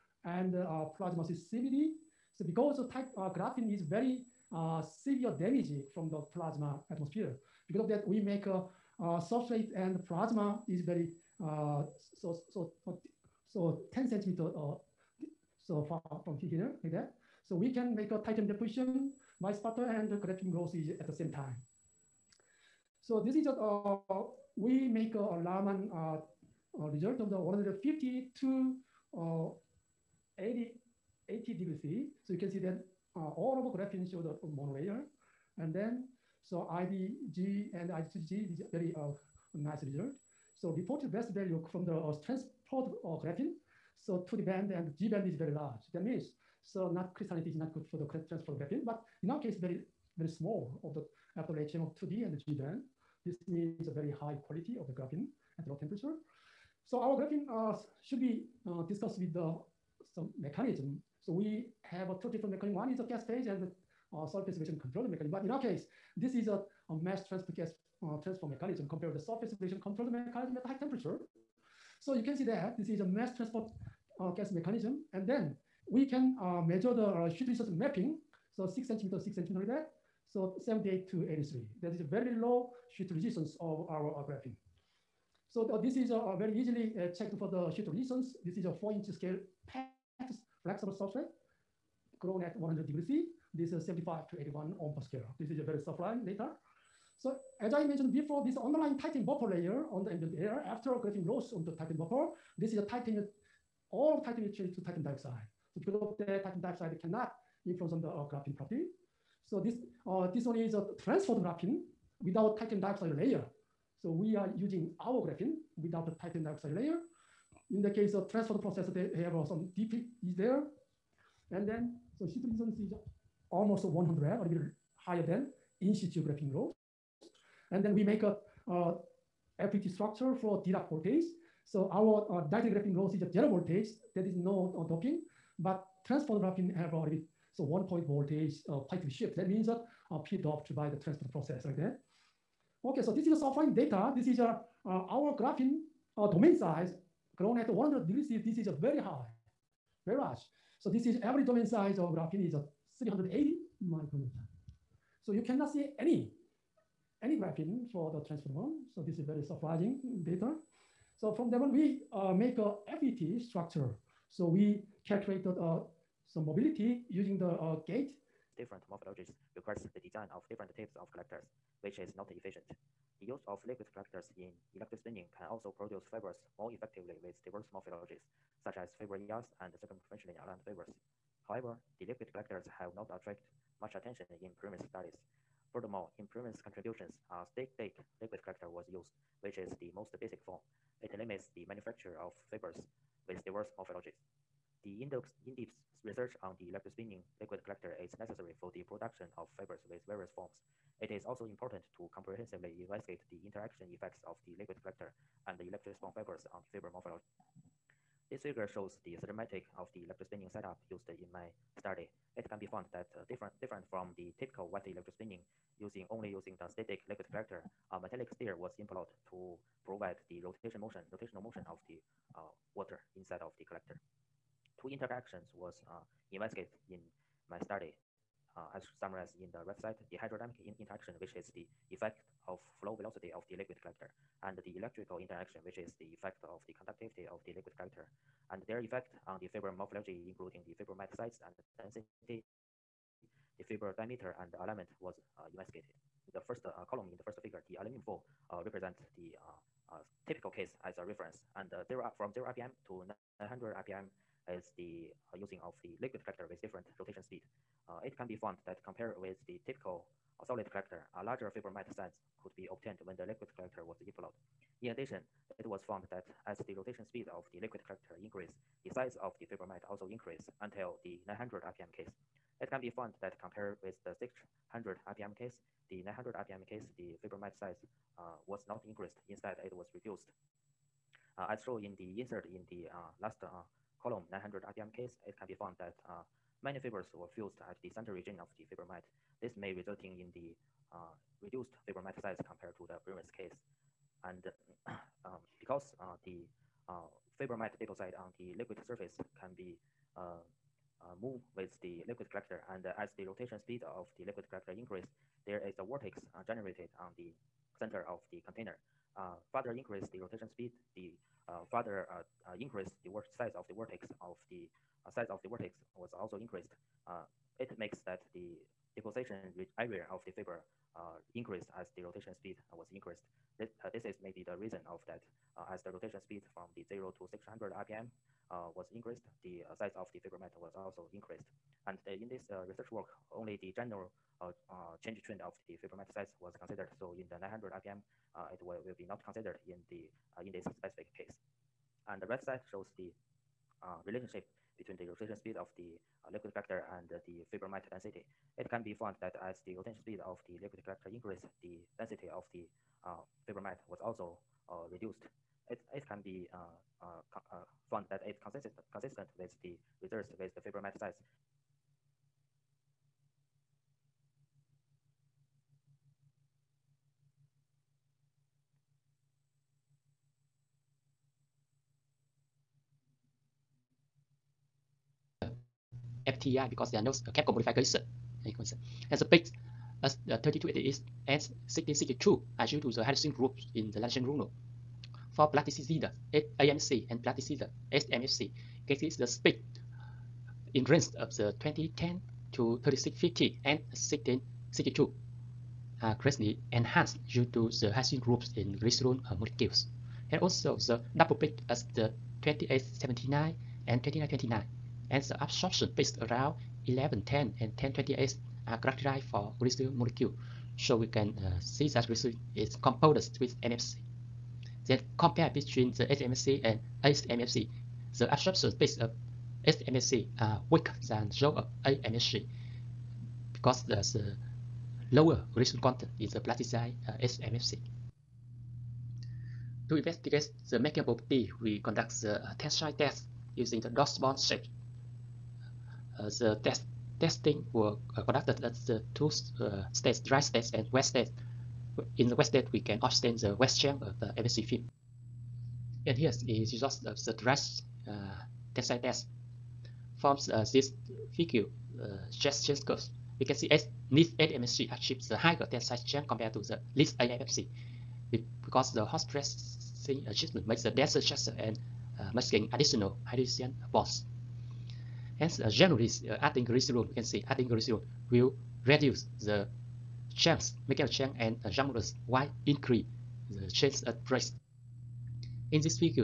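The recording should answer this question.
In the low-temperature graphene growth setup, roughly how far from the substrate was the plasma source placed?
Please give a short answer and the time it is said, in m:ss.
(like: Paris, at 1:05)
10 centimeters, at 0:13.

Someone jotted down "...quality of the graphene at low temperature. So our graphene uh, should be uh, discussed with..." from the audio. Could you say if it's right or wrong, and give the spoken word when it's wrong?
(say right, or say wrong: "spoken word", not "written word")
right.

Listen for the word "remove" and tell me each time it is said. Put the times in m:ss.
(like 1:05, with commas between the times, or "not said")
not said.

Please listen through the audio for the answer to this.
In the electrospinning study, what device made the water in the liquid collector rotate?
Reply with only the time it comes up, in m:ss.
3:37.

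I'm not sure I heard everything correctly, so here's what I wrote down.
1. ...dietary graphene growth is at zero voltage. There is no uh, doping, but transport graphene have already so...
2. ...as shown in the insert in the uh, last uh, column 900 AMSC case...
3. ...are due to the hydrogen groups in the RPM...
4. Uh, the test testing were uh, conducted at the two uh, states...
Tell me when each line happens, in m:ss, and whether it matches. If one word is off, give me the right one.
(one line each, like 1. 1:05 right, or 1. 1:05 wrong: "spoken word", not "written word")
1. 2:12 right
2. 4:41 wrong: "RPM", not "AMSC"
3. 6:22 wrong: "Latin", not "RPM"
4. 7:16 right.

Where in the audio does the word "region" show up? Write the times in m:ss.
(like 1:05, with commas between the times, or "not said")
4:48.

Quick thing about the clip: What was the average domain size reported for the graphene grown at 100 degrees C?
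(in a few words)
380 micrometers.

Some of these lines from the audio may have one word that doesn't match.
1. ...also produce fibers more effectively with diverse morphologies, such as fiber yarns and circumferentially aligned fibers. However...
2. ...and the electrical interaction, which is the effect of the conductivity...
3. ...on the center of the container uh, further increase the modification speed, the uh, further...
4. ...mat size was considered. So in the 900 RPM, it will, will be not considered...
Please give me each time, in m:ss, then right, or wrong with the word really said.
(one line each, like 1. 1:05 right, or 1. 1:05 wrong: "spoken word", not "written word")
1. 2:55 right
2. 3:54 right
3. 5:06 wrong: "rotation", not "modification"
4. 5:35 right.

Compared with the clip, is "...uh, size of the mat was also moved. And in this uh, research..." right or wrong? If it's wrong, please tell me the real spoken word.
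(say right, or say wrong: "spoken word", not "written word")
wrong: "increased", not "moved".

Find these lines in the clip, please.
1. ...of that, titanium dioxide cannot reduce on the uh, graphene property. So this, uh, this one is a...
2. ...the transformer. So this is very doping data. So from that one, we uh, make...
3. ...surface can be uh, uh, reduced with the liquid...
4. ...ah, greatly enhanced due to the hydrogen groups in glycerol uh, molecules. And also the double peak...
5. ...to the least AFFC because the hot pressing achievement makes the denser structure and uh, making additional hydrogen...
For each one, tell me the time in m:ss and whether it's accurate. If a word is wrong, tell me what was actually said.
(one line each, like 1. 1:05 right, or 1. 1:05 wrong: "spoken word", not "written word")
1. 1:45 wrong: "influence", not "reduce"
2. 2:38 wrong: "surprising", not "doping"
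3. 4:58 wrong: "moved", not "reduced"
4. 6:36 right
5. 7:36 right.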